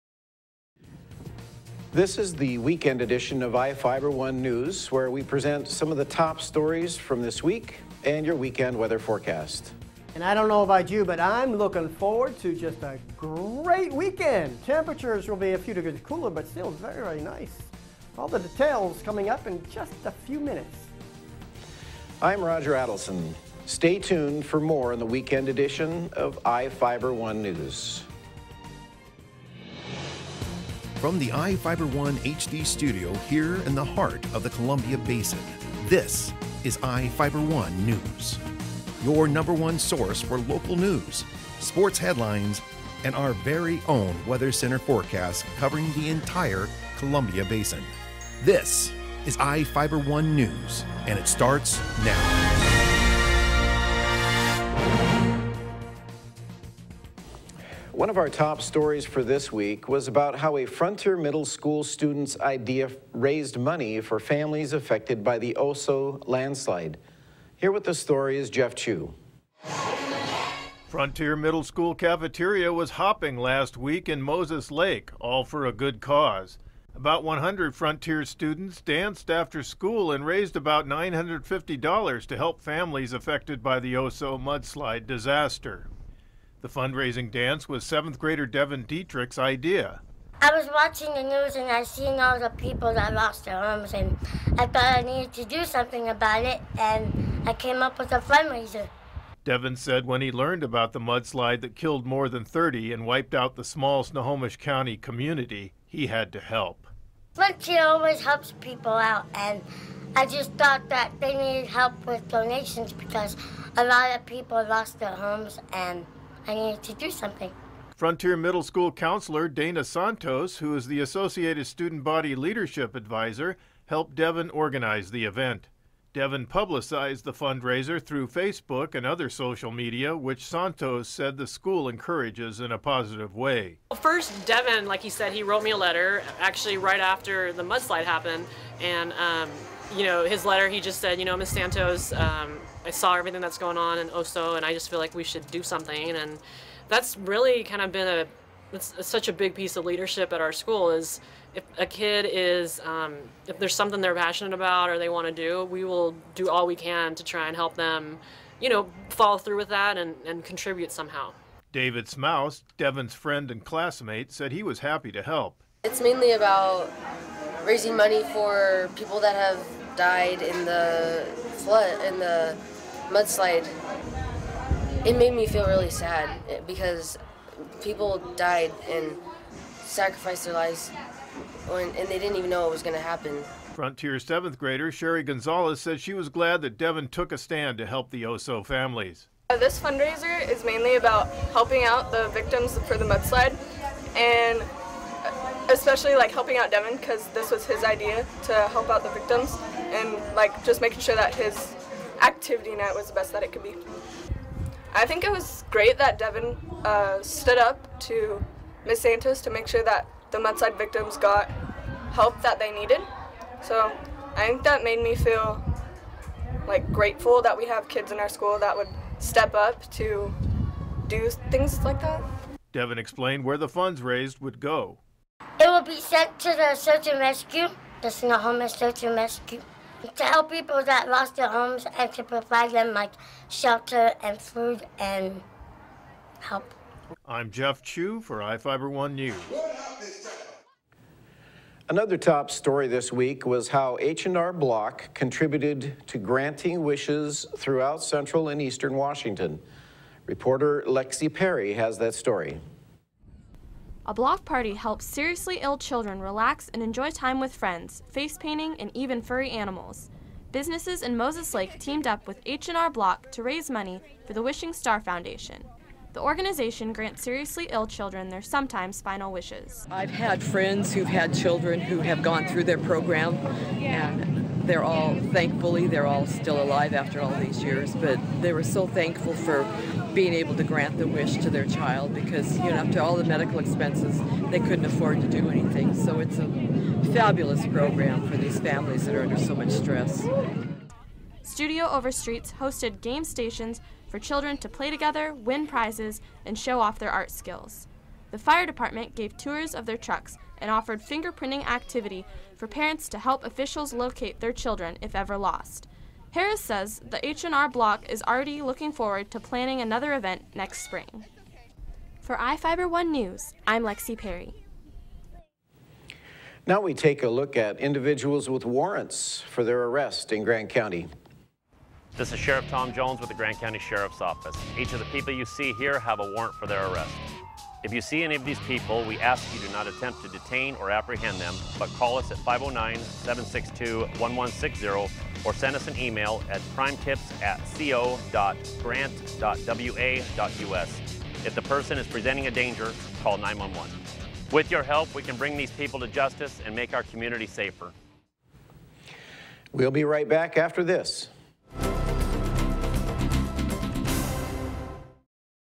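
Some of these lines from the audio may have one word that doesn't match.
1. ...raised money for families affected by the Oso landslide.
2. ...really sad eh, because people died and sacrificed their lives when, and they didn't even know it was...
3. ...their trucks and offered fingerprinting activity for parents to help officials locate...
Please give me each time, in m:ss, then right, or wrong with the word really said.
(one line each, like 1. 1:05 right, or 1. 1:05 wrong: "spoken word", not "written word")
1. 1:03 right
2. 2:55 right
3. 4:59 right.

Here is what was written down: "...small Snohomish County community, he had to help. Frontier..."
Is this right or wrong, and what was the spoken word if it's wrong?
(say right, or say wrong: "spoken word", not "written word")
right.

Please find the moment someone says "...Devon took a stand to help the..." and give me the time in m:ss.
3:06.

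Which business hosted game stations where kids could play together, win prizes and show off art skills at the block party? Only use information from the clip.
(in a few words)
Studio Over Streets.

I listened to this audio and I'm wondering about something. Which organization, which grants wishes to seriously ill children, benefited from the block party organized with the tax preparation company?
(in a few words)
Wishing Star Foundation.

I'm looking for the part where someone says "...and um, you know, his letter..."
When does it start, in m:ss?
2:18.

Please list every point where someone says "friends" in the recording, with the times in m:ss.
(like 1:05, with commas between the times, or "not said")
2:43, 4:17, 4:30.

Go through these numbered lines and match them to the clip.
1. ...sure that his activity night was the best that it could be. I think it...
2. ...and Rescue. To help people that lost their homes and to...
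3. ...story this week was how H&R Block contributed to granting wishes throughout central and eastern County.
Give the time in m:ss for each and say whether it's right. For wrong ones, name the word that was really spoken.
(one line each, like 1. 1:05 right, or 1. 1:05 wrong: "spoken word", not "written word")
1. 3:20 right
2. 3:49 right
3. 4:02 wrong: "Washington", not "County".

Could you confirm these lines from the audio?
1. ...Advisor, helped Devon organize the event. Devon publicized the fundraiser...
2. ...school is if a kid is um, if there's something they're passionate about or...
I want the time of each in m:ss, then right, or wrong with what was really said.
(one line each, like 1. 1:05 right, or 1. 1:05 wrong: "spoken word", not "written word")
1. 2:02 right
2. 2:30 right.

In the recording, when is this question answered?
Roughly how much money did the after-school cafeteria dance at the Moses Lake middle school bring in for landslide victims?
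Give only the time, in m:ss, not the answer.
1:20.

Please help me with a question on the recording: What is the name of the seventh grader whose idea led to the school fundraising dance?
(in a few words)
Devin Dietrich.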